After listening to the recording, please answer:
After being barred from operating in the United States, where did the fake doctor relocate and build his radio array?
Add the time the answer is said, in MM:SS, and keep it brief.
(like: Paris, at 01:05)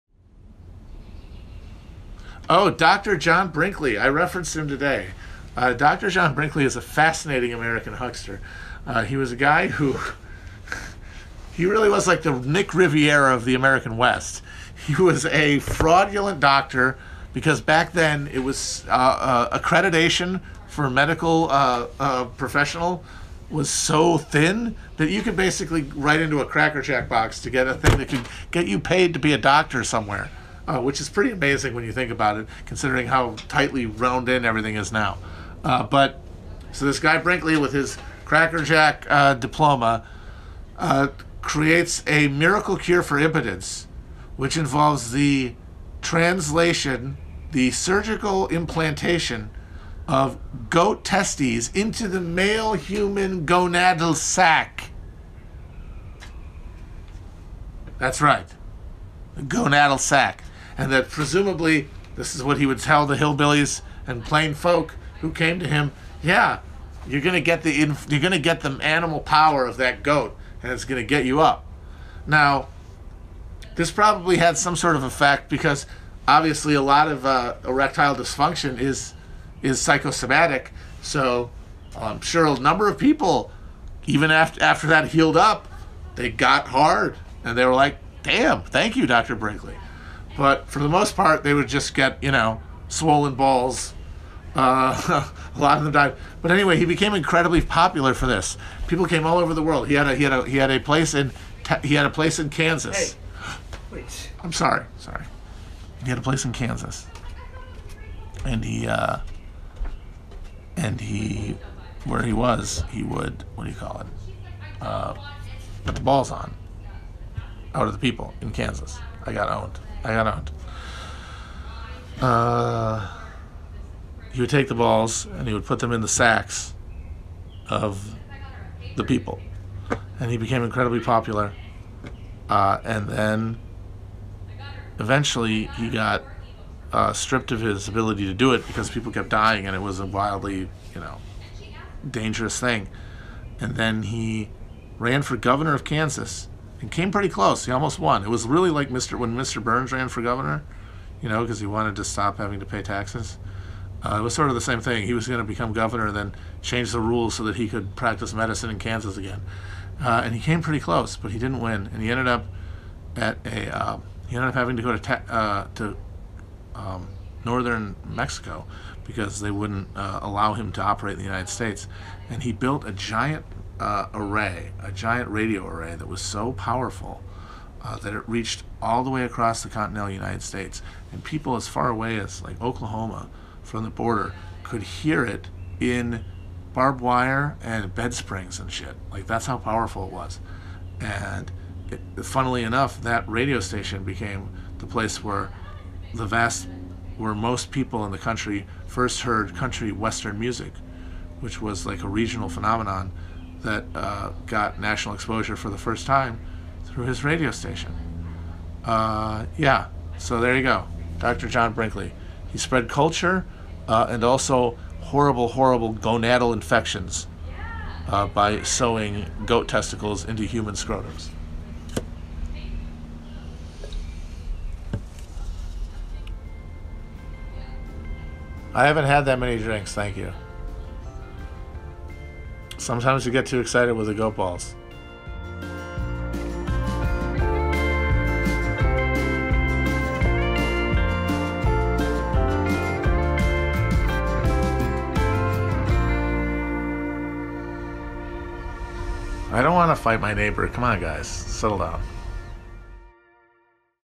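Northern Mexico, at 02:47.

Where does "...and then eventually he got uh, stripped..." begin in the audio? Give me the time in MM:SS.
02:12.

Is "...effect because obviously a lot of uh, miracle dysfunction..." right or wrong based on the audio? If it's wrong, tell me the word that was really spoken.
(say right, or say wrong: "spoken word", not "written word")
wrong: "erectile", not "miracle".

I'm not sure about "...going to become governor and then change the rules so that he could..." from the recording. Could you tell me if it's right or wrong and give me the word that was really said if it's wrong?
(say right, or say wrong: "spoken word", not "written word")
right.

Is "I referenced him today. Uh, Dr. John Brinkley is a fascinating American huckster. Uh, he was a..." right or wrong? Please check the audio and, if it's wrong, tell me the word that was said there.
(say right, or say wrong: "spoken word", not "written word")
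right.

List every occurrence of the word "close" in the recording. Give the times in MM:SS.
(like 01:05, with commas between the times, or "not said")
02:27, 02:40.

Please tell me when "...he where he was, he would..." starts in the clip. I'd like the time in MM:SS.
01:51.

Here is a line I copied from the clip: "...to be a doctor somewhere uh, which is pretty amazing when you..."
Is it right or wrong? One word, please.
right.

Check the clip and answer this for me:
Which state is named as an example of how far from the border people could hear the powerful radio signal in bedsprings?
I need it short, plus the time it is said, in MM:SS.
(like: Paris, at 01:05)
Oklahoma, at 03:02.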